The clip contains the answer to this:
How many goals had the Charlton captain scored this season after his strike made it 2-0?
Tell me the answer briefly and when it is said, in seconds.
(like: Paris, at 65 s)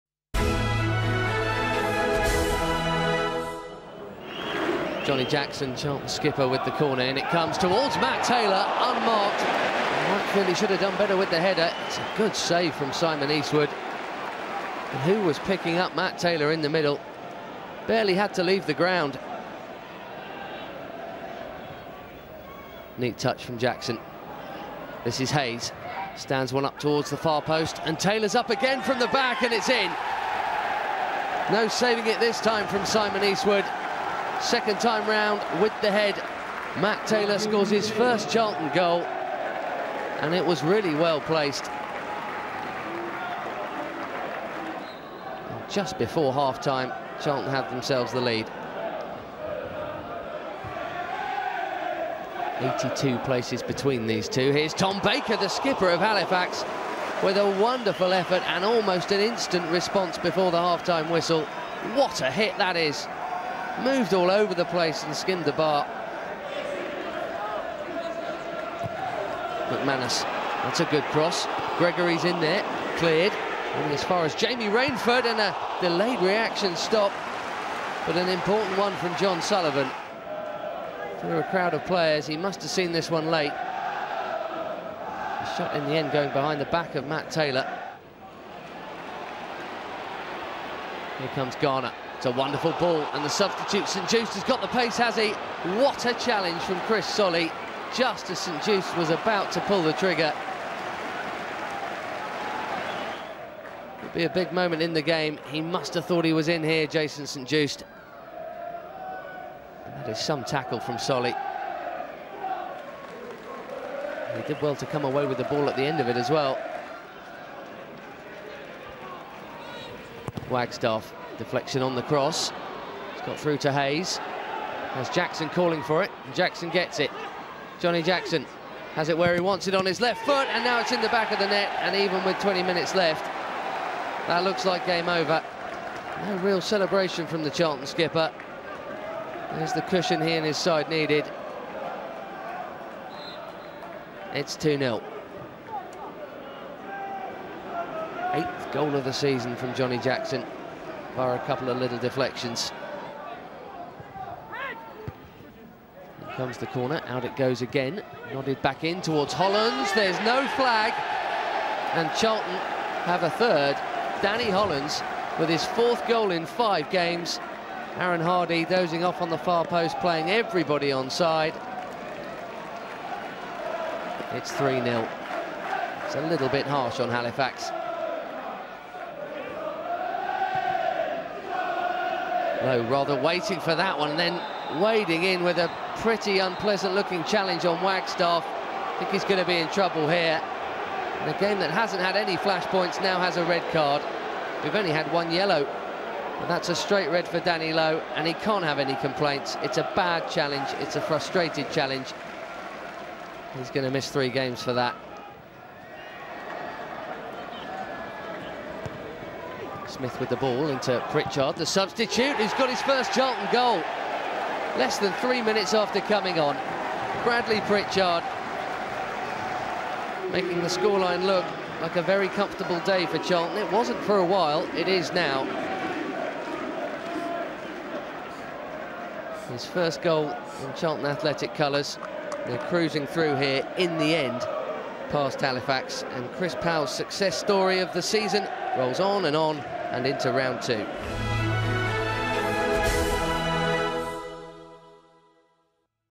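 8, at 148 s.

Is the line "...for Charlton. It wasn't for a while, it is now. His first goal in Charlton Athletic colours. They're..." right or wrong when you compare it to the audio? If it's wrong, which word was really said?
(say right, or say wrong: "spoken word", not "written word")
right.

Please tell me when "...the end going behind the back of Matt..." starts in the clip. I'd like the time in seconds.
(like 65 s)
85 s.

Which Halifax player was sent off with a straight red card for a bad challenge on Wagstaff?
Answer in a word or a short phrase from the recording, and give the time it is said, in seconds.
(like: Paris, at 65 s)
Danny Lowe, at 197 s.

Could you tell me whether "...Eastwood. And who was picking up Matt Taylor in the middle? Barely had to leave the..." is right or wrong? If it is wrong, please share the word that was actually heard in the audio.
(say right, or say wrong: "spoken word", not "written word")
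right.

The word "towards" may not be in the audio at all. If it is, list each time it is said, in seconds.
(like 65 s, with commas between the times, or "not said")
7 s, 26 s, 159 s.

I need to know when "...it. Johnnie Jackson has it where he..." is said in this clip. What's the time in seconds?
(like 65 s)
126 s.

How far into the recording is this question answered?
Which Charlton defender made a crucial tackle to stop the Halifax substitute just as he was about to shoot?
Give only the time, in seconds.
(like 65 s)
96 s.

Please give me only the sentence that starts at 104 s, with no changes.
It'll be a big moment in the game.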